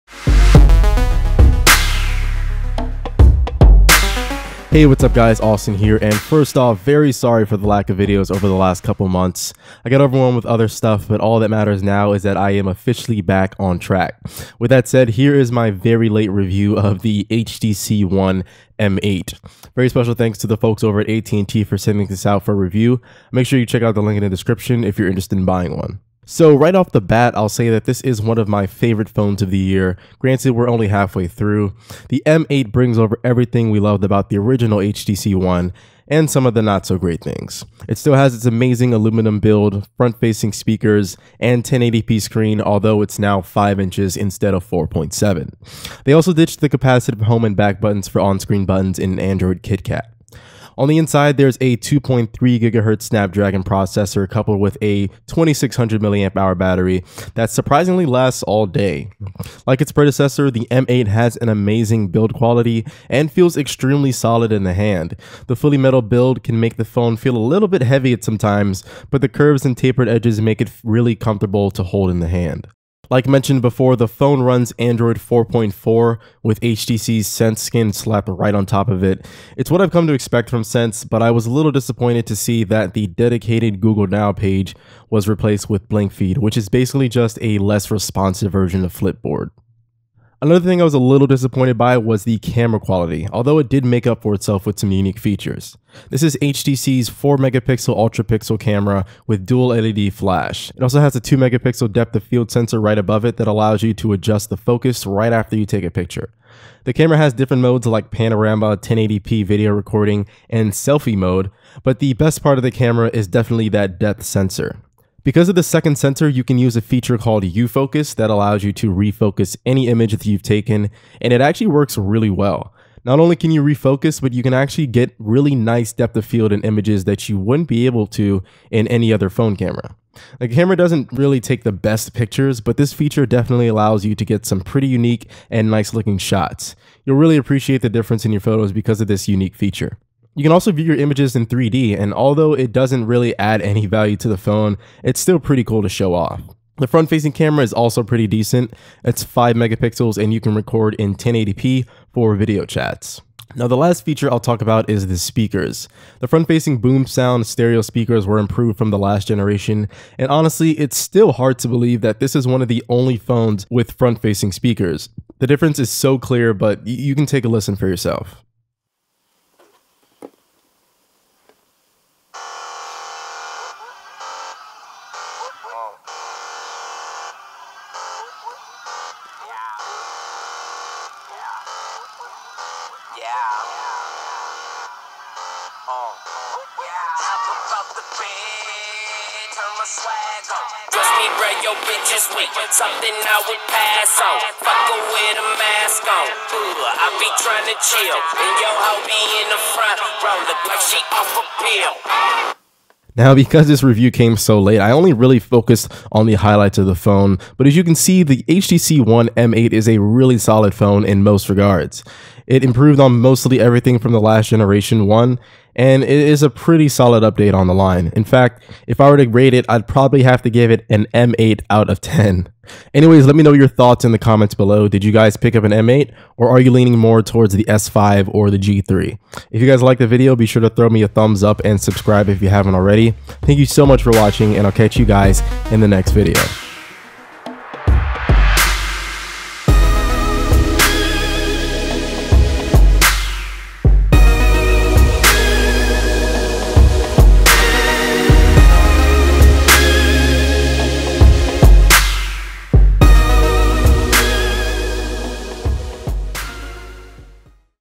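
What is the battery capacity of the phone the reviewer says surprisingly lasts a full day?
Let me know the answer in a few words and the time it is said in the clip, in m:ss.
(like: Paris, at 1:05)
2600 milliamp hours, at 0:55.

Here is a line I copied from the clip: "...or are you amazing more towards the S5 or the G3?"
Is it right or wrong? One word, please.
wrong.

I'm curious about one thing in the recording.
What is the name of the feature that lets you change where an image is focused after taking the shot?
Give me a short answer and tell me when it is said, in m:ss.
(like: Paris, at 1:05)
U-Focus, at 1:57.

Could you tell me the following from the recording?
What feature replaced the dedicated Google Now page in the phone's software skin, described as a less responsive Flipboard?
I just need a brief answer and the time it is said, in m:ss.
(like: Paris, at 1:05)
Blink Feed, at 1:25.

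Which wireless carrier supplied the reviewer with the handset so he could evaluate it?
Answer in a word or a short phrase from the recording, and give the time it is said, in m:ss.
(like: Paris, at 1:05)
AT&T, at 0:21.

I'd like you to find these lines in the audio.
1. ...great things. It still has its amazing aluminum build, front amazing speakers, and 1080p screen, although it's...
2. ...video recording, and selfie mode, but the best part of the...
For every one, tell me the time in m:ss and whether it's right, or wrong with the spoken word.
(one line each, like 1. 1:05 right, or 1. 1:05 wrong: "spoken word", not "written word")
1. 0:36 wrong: "facing", not "amazing"
2. 1:49 right.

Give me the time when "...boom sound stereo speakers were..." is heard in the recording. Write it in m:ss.
2:36.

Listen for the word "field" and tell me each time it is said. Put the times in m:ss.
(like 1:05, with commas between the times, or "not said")
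1:42, 2:06.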